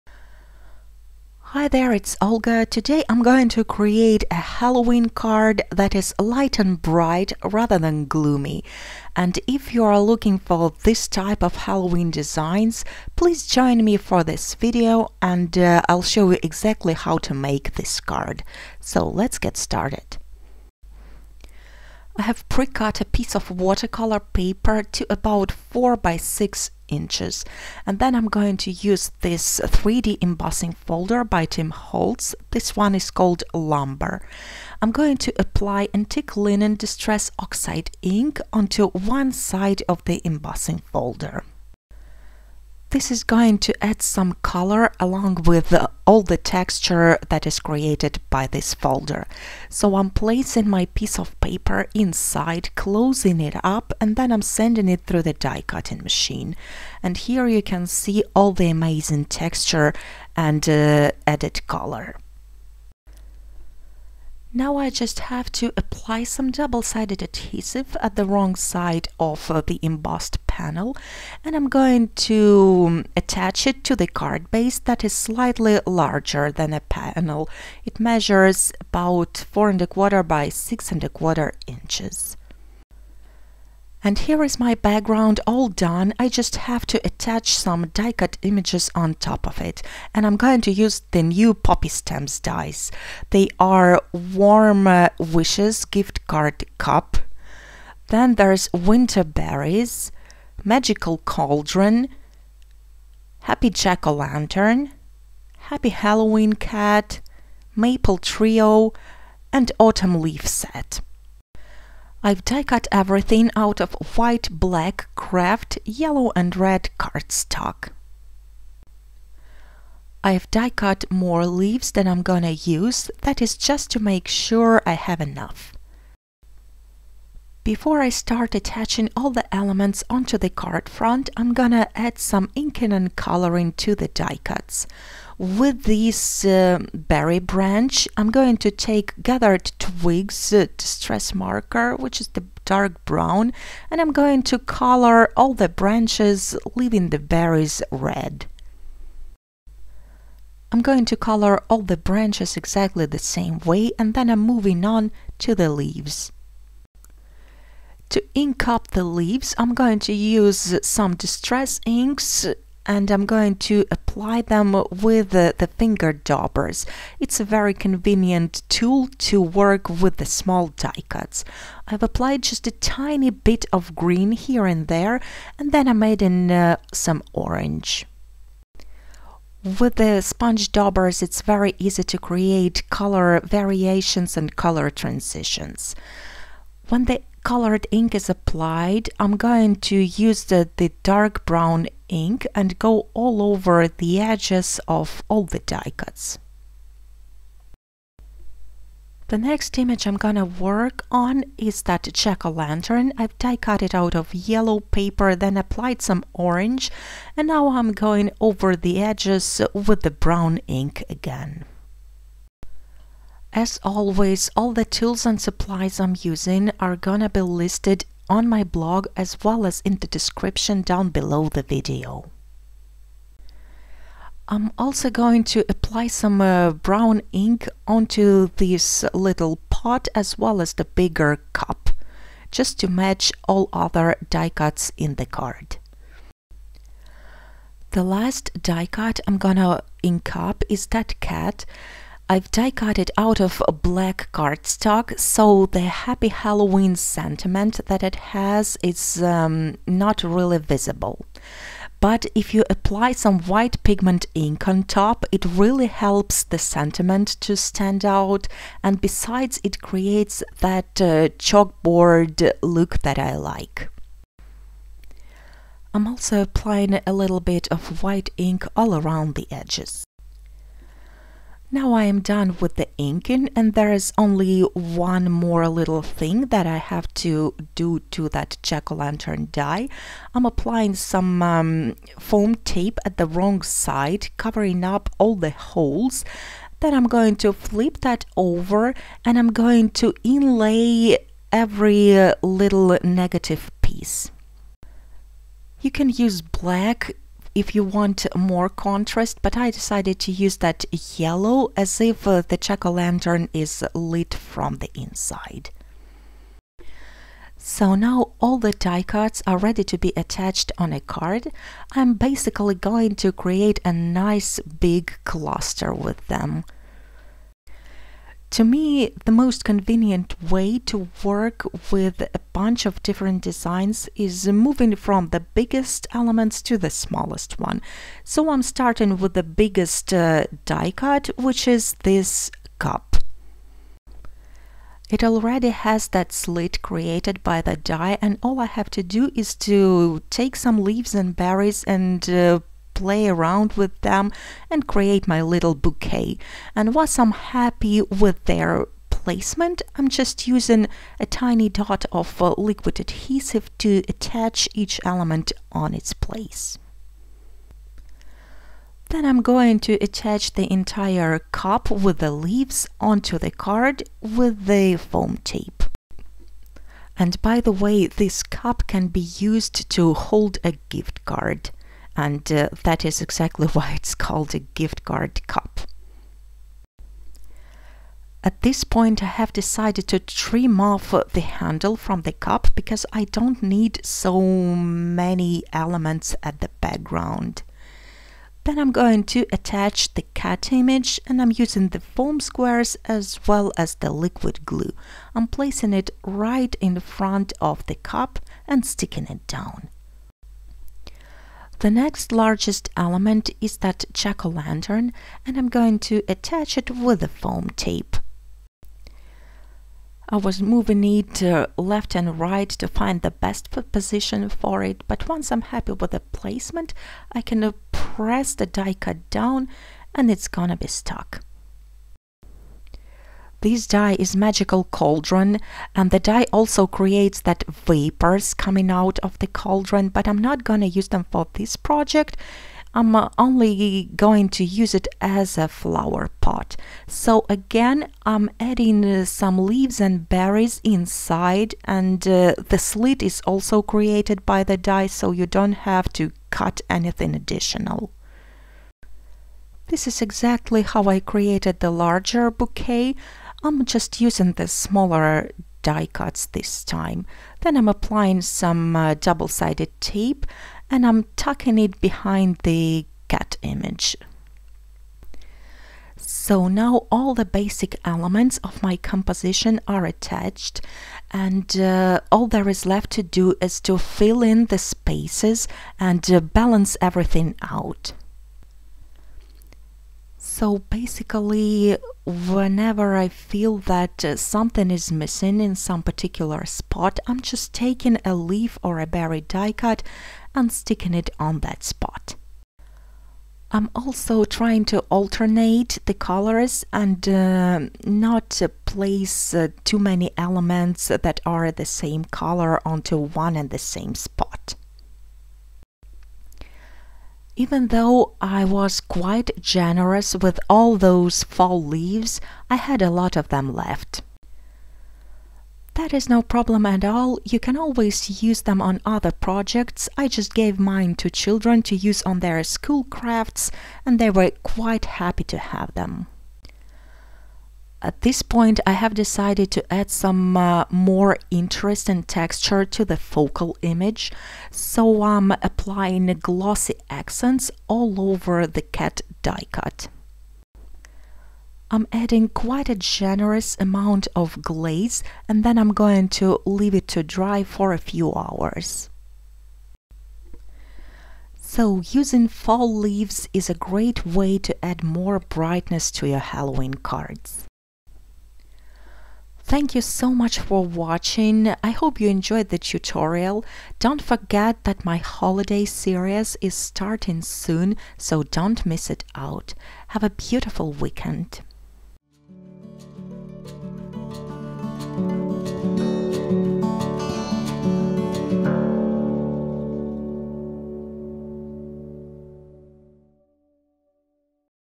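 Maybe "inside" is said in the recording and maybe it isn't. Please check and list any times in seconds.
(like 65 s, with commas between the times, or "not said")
51 s, 304 s, 440 s.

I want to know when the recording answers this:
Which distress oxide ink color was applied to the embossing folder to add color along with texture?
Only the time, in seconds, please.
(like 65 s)
35 s.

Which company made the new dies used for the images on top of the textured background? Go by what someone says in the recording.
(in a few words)
Poppy Stamps.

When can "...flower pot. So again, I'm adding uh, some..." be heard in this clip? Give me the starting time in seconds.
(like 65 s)
435 s.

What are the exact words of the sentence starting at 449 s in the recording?
This is exactly how I created the larger bouquet.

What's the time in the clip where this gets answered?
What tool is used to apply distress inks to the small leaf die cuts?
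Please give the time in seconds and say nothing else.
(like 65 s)
165 s.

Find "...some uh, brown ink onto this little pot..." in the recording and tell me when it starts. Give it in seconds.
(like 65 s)
226 s.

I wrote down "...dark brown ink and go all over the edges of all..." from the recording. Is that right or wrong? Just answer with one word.
right.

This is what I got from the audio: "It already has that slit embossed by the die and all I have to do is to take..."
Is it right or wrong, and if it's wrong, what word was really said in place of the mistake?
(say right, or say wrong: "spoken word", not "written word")
wrong: "created", not "embossed".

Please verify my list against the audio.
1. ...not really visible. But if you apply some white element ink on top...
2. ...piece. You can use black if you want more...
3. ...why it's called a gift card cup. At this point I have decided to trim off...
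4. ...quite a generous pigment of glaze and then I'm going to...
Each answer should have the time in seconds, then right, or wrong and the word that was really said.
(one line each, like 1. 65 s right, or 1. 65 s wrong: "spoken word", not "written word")
1. 249 s wrong: "pigment", not "element"
2. 293 s right
3. 373 s right
4. 542 s wrong: "amount", not "pigment".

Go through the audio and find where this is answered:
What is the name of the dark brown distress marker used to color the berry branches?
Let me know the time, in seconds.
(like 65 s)
139 s.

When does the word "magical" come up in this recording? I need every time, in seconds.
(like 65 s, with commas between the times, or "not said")
100 s, 424 s.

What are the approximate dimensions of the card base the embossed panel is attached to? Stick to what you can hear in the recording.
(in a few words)
4 1/4 by 6 1/4 inches.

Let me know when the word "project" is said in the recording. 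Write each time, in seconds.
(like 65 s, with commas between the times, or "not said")
431 s, 519 s.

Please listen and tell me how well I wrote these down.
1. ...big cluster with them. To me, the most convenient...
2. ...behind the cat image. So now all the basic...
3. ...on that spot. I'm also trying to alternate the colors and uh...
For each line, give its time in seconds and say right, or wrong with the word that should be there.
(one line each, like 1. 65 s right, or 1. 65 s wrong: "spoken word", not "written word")
1. 314 s right
2. 462 s right
3. 491 s right.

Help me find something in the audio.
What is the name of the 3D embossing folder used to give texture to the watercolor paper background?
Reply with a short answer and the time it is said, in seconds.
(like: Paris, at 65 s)
Lumber, at 33 s.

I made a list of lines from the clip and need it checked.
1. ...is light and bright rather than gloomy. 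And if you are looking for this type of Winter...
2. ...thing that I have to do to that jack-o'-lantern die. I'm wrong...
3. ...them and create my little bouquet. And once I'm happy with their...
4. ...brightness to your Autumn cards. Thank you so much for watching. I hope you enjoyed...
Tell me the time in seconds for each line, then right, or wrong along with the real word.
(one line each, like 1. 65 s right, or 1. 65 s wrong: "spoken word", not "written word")
1. 5 s wrong: "Halloween", not "Winter"
2. 276 s wrong: "applying", not "wrong"
3. 344 s right
4. 555 s wrong: "Halloween", not "Autumn".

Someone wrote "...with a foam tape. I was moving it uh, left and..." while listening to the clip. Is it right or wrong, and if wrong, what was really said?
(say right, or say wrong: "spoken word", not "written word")
right.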